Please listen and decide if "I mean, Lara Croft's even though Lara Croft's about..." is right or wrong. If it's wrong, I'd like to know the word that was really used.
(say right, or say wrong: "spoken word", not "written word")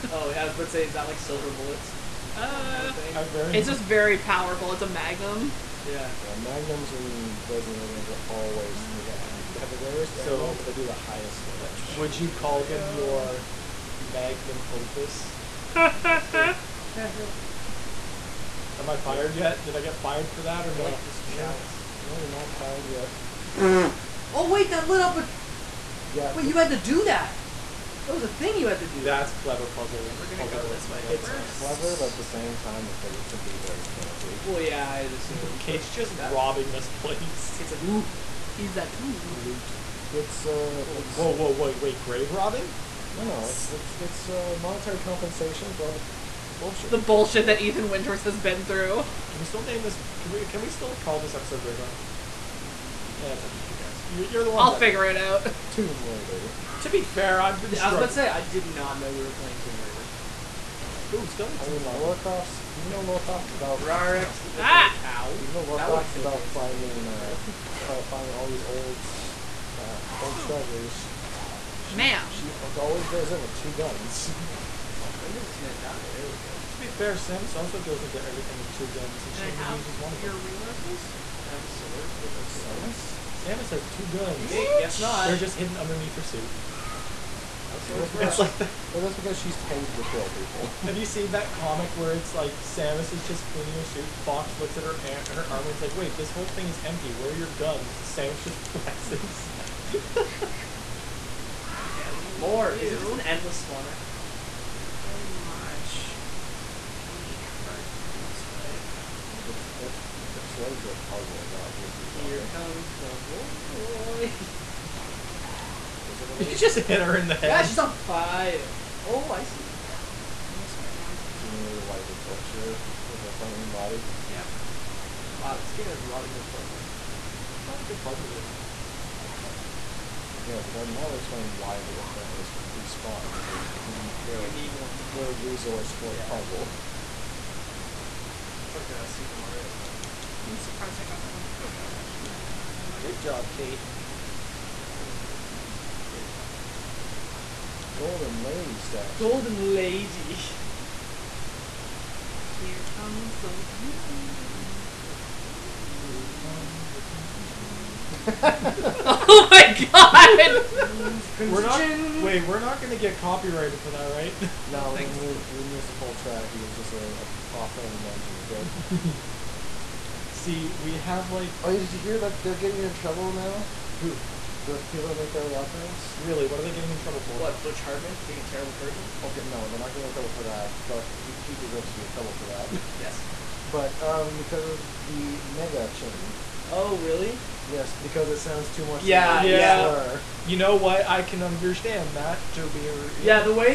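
right.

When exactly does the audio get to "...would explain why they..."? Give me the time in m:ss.
2:11.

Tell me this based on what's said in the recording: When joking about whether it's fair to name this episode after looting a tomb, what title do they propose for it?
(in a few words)
Grave Robin.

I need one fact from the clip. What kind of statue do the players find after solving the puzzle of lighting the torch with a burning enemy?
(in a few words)
Golden Lady statue.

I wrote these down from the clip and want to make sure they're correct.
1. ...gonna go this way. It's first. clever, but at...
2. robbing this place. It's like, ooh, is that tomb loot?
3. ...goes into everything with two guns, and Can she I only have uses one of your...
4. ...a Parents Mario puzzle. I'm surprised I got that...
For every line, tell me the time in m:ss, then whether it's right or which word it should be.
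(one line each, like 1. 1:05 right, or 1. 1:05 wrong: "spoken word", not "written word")
1. 0:30 right
2. 0:36 right
3. 1:17 right
4. 2:18 wrong: "Super", not "Parents".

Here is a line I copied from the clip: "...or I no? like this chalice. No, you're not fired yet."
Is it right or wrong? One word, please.
right.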